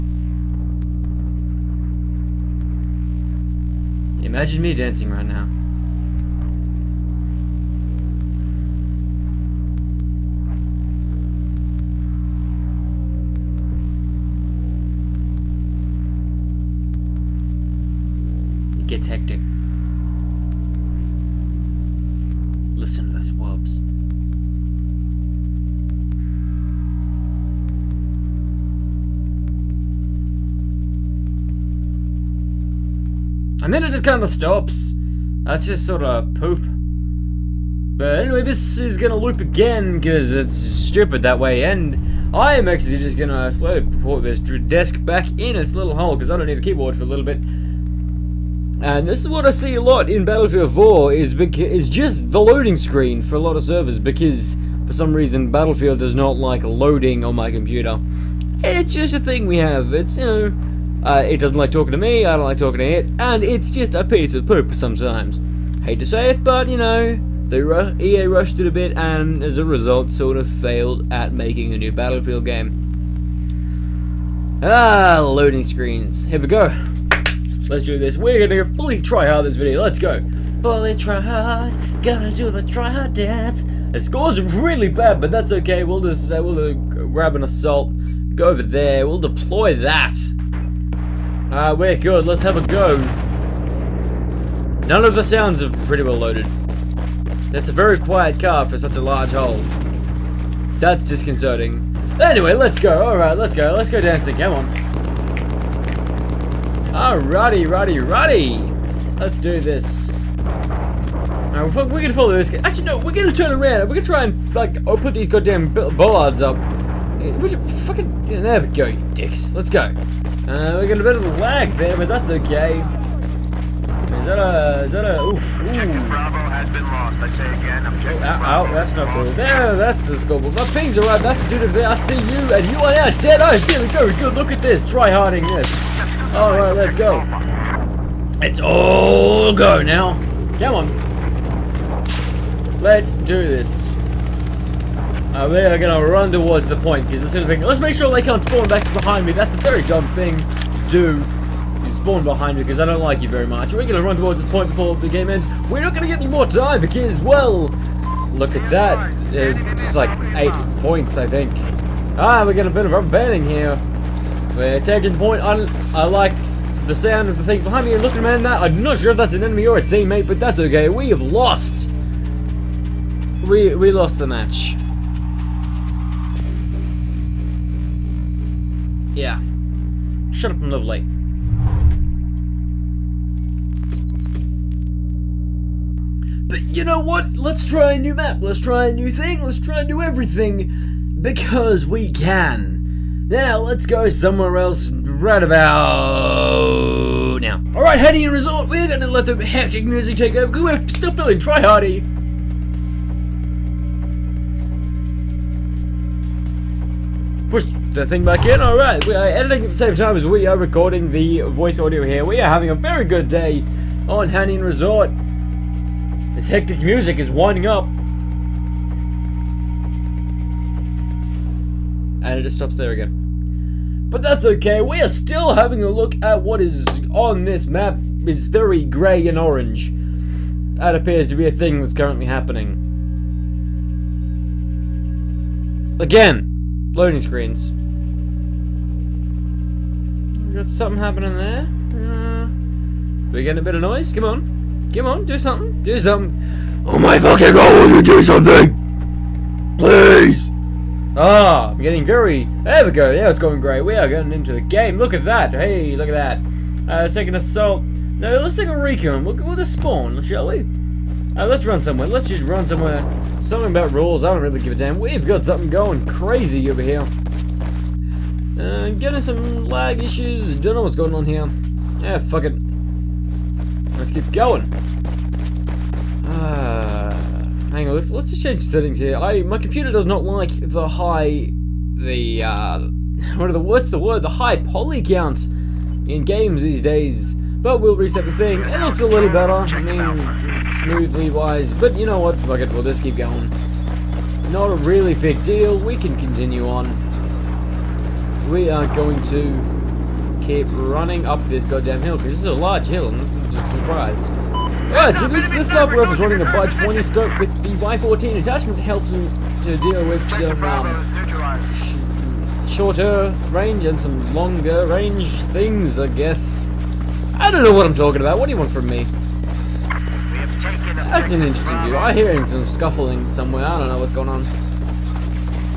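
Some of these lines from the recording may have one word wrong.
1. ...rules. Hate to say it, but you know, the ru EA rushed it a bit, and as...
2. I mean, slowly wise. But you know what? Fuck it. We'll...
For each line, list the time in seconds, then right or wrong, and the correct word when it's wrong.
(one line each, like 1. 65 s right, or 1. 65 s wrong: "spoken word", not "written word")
1. 64 s wrong: "sometimes", not "rules"
2. 289 s wrong: "smoothly", not "slowly".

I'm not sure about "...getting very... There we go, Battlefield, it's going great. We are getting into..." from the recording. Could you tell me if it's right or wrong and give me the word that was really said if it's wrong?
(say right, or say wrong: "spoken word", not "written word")
wrong: "Yeah", not "Battlefield".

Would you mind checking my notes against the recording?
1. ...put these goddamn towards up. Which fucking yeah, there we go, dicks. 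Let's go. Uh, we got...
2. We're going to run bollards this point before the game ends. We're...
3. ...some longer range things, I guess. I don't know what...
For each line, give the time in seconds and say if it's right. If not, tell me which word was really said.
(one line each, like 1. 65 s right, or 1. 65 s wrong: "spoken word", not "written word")
1. 114 s wrong: "bollards", not "towards"
2. 153 s wrong: "towards", not "bollards"
3. 313 s right.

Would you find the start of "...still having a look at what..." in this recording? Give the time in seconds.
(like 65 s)
225 s.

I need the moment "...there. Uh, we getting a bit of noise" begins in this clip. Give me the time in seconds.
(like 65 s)
241 s.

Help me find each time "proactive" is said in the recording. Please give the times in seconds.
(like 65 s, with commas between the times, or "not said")
not said.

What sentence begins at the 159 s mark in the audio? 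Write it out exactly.
It's uh, like eight points, I think.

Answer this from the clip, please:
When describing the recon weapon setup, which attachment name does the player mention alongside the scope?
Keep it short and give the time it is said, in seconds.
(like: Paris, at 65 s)
Y14, at 307 s.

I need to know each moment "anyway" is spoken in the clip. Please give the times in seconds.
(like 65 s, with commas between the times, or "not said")
38 s, 102 s.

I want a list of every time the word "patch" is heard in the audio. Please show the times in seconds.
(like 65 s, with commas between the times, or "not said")
not said.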